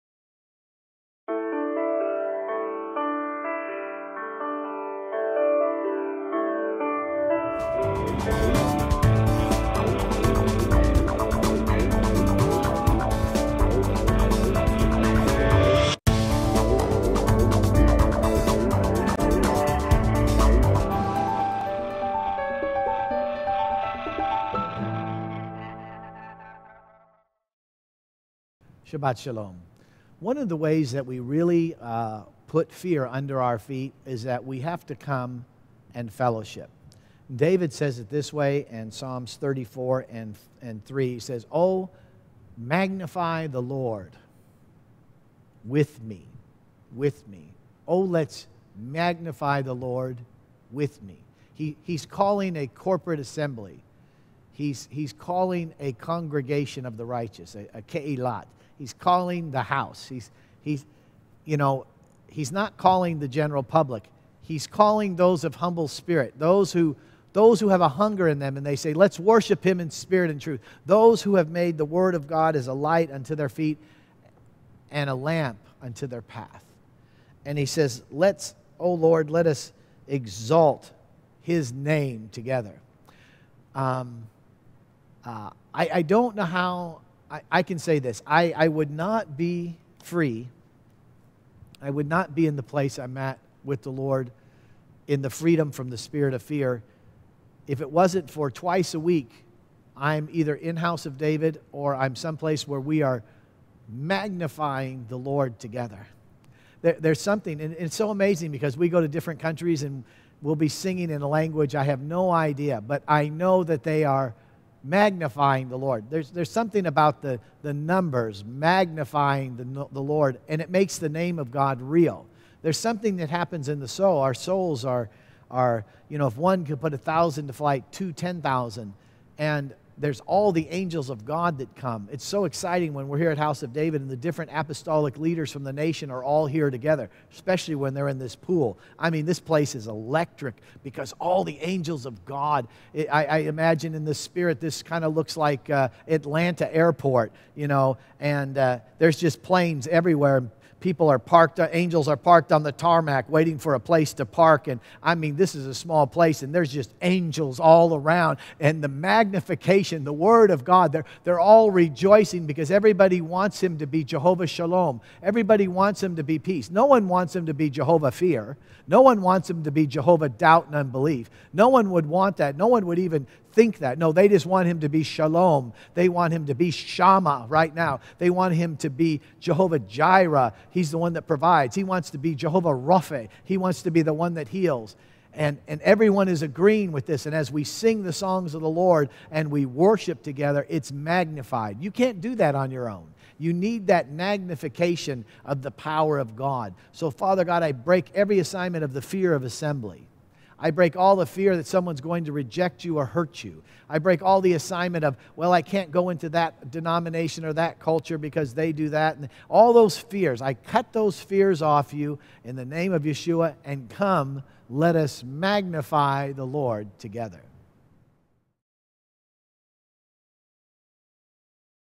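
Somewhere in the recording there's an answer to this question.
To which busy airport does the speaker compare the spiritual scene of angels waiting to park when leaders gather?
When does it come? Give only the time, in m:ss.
2:26.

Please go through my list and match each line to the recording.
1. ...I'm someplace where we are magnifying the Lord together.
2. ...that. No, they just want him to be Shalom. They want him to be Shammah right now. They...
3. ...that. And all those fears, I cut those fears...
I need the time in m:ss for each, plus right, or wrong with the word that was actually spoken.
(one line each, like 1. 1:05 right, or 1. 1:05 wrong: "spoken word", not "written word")
1. 1:41 right
2. 2:53 right
3. 3:28 right.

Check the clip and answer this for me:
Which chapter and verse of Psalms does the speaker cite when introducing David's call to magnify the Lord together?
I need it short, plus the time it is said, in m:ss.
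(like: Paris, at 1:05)
Psalms 34:3, at 0:38.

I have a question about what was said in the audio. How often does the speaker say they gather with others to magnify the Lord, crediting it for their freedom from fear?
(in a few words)
Twice a week.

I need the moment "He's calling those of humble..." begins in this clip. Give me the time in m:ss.
1:04.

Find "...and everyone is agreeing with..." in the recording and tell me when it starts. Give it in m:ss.
3:05.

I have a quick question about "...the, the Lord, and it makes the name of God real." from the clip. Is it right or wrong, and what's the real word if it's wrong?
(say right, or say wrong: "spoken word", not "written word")
right.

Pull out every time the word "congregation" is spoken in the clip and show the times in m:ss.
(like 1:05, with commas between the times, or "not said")
0:55.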